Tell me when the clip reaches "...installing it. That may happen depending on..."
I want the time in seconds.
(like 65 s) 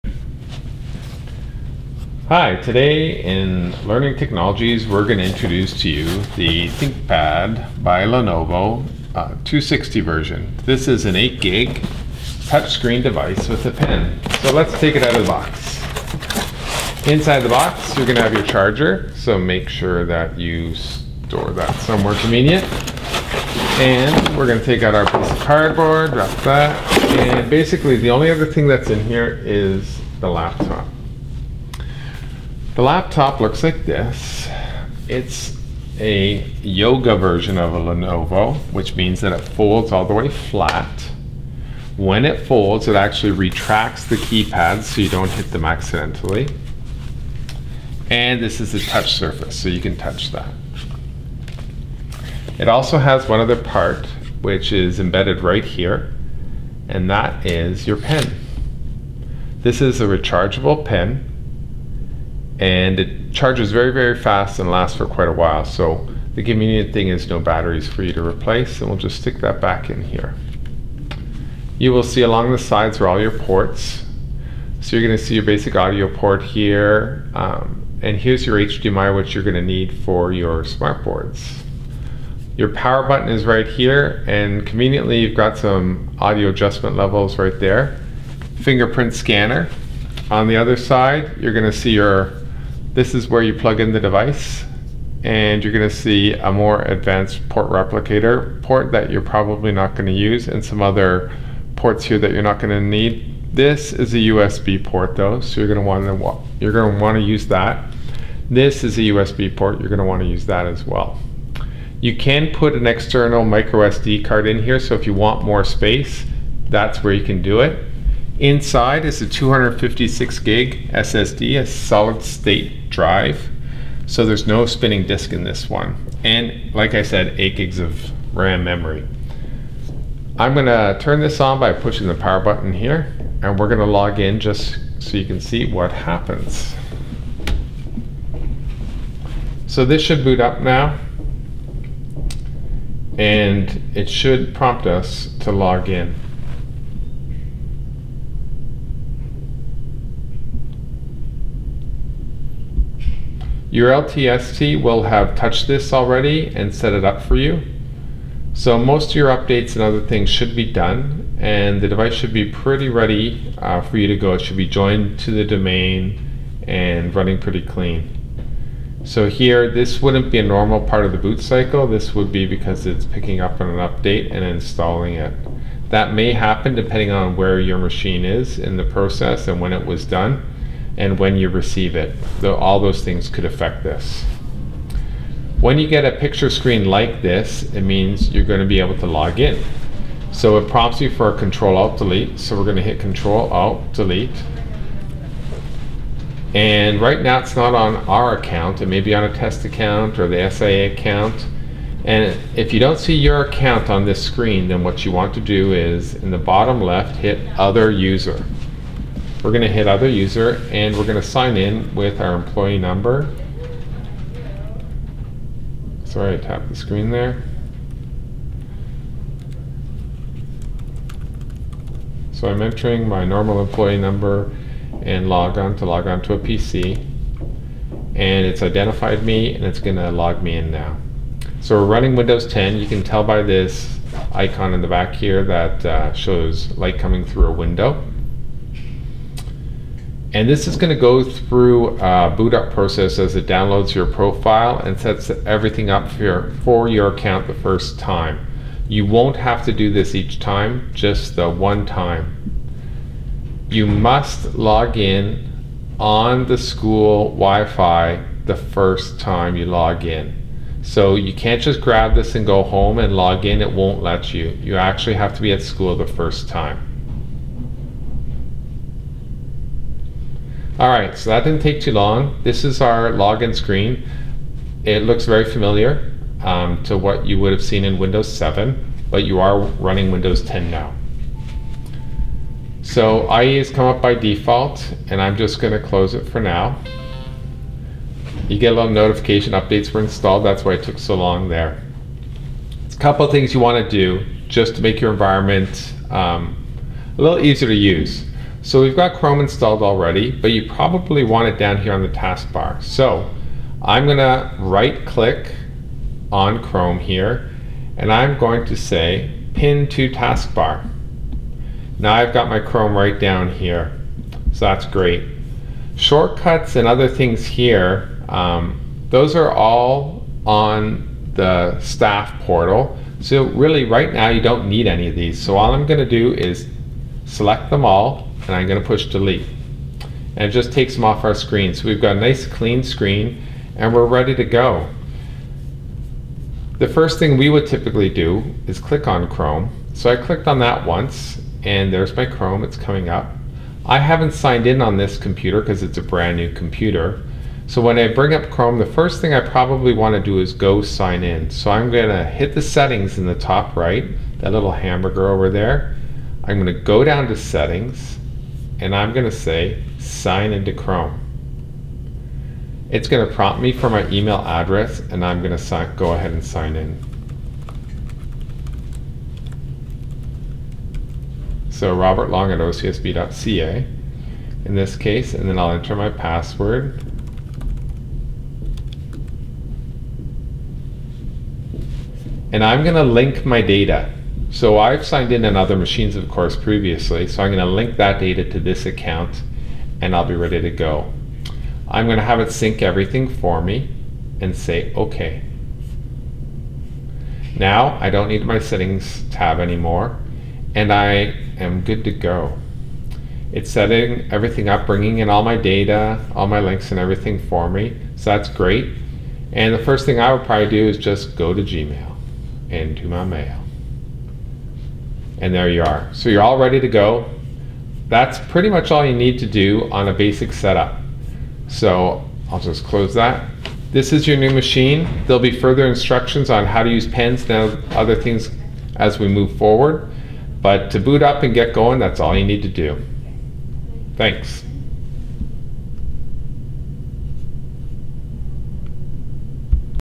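174 s.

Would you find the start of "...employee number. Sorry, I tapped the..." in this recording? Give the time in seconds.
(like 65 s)
212 s.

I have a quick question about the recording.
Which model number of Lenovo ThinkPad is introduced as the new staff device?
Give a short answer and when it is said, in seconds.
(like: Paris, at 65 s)
260, at 9 s.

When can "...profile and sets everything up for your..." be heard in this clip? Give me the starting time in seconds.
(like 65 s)
244 s.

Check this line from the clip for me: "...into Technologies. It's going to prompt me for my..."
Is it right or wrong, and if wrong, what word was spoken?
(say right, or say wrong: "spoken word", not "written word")
wrong: "Chrome", not "Technologies".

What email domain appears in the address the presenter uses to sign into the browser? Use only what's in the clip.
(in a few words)
OCSB.ca.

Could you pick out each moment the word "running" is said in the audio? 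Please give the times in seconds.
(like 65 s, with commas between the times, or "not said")
167 s, 231 s, 279 s.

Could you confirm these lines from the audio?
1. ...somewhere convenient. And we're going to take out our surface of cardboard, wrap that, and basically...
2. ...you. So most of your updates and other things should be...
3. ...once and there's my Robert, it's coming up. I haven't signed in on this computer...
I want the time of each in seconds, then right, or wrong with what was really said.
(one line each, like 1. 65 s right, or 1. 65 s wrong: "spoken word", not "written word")
1. 21 s wrong: "piece", not "surface"
2. 157 s right
3. 340 s wrong: "Chrome", not "Robert".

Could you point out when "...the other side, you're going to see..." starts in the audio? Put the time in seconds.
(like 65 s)
90 s.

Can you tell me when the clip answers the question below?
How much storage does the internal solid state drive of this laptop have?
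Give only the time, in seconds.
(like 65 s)
119 s.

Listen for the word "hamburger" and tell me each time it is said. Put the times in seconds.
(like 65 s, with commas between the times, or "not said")
354 s.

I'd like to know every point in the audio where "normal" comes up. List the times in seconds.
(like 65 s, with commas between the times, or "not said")
170 s, 223 s.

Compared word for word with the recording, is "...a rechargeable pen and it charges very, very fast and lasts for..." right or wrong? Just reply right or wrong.
right.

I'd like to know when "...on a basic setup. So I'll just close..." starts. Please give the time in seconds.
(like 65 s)
419 s.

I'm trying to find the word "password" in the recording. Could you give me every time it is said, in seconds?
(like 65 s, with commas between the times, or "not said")
376 s.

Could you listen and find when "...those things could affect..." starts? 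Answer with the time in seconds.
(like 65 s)
182 s.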